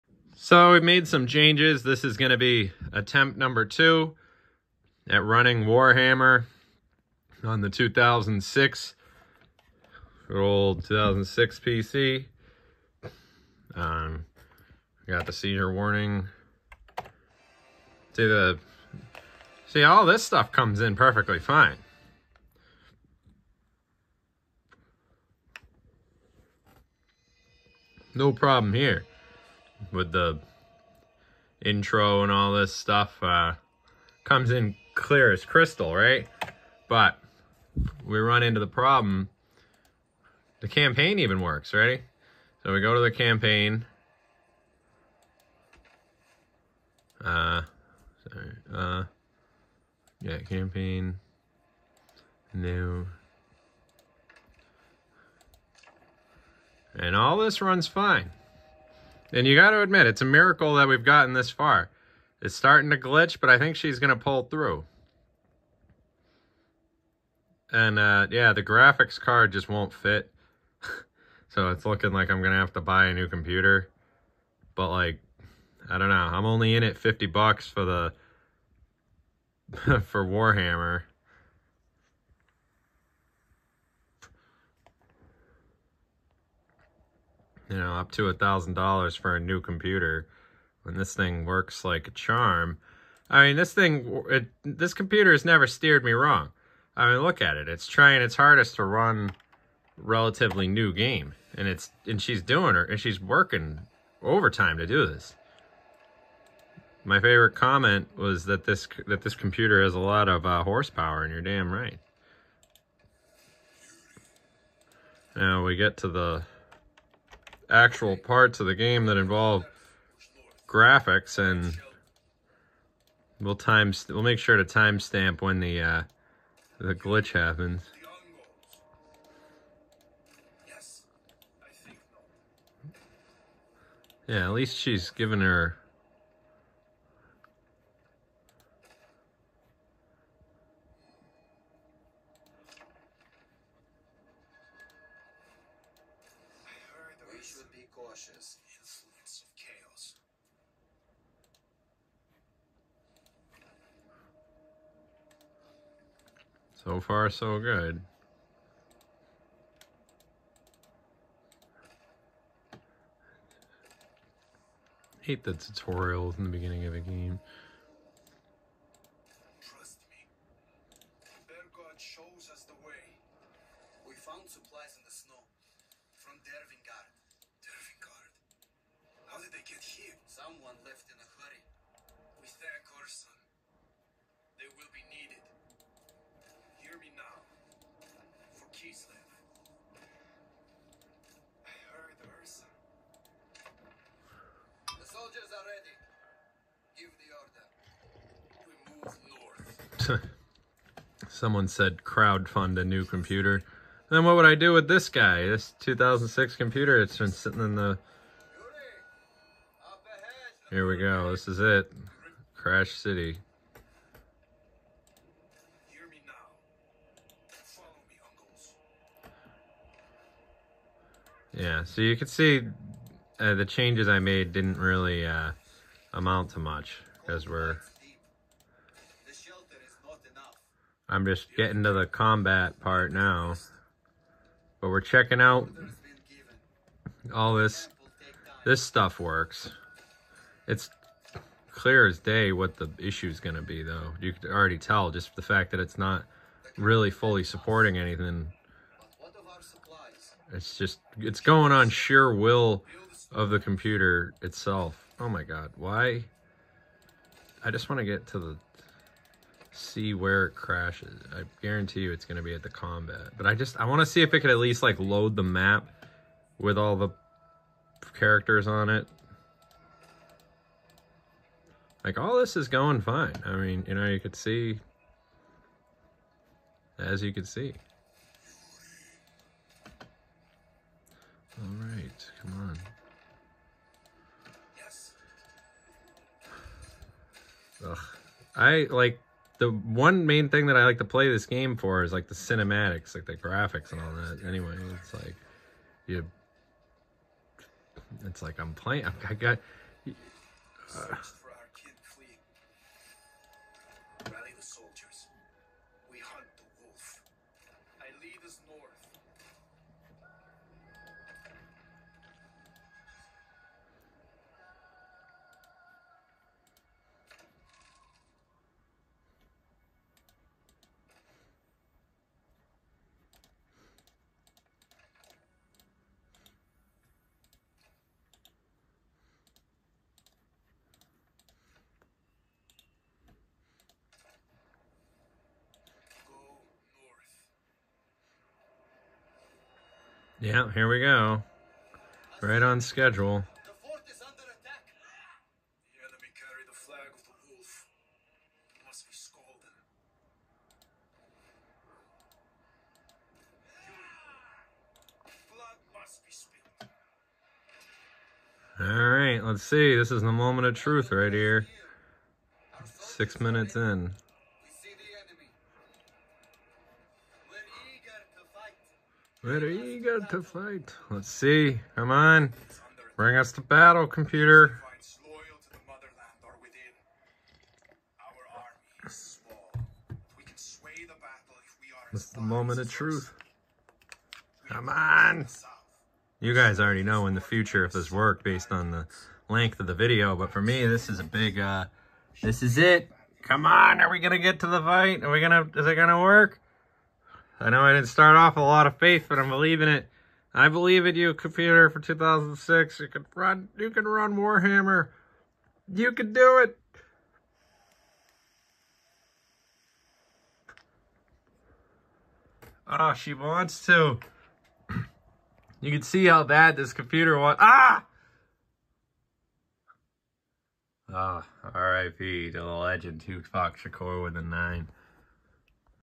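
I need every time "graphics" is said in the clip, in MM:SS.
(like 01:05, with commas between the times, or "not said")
01:08, 02:00, 04:53.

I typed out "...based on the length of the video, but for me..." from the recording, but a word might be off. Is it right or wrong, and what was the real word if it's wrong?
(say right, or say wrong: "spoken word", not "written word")
right.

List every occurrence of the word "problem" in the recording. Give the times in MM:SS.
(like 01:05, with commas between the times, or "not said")
00:28, 00:38.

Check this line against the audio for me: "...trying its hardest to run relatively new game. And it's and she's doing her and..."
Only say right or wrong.
right.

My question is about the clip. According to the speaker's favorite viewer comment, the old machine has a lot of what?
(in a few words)
horsepower.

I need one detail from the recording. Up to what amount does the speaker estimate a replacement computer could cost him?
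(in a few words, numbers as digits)
$1,000.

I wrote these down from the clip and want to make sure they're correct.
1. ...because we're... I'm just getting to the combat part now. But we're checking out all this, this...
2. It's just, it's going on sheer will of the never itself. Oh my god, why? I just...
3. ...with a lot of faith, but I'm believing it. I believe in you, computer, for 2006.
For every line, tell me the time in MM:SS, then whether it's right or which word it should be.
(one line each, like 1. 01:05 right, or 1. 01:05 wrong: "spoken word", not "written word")
1. 03:47 right
2. 04:10 wrong: "computer", not "never"
3. 06:38 right.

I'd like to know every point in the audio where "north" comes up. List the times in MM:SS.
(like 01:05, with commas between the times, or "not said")
03:20, 05:08.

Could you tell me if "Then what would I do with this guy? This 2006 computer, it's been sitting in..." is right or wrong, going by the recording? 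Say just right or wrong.
right.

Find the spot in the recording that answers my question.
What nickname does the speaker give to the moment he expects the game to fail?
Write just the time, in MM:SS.
03:32.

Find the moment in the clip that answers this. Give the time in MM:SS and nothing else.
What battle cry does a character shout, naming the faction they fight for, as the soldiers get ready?
03:08.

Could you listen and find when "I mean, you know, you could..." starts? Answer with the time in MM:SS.
04:33.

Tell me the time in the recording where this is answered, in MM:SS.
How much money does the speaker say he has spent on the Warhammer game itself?
01:16.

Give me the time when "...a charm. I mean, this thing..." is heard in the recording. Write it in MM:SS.
01:32.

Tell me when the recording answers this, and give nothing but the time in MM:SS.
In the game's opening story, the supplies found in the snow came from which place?
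02:56.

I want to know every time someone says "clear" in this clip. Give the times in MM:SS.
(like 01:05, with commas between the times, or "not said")
00:34, 04:01.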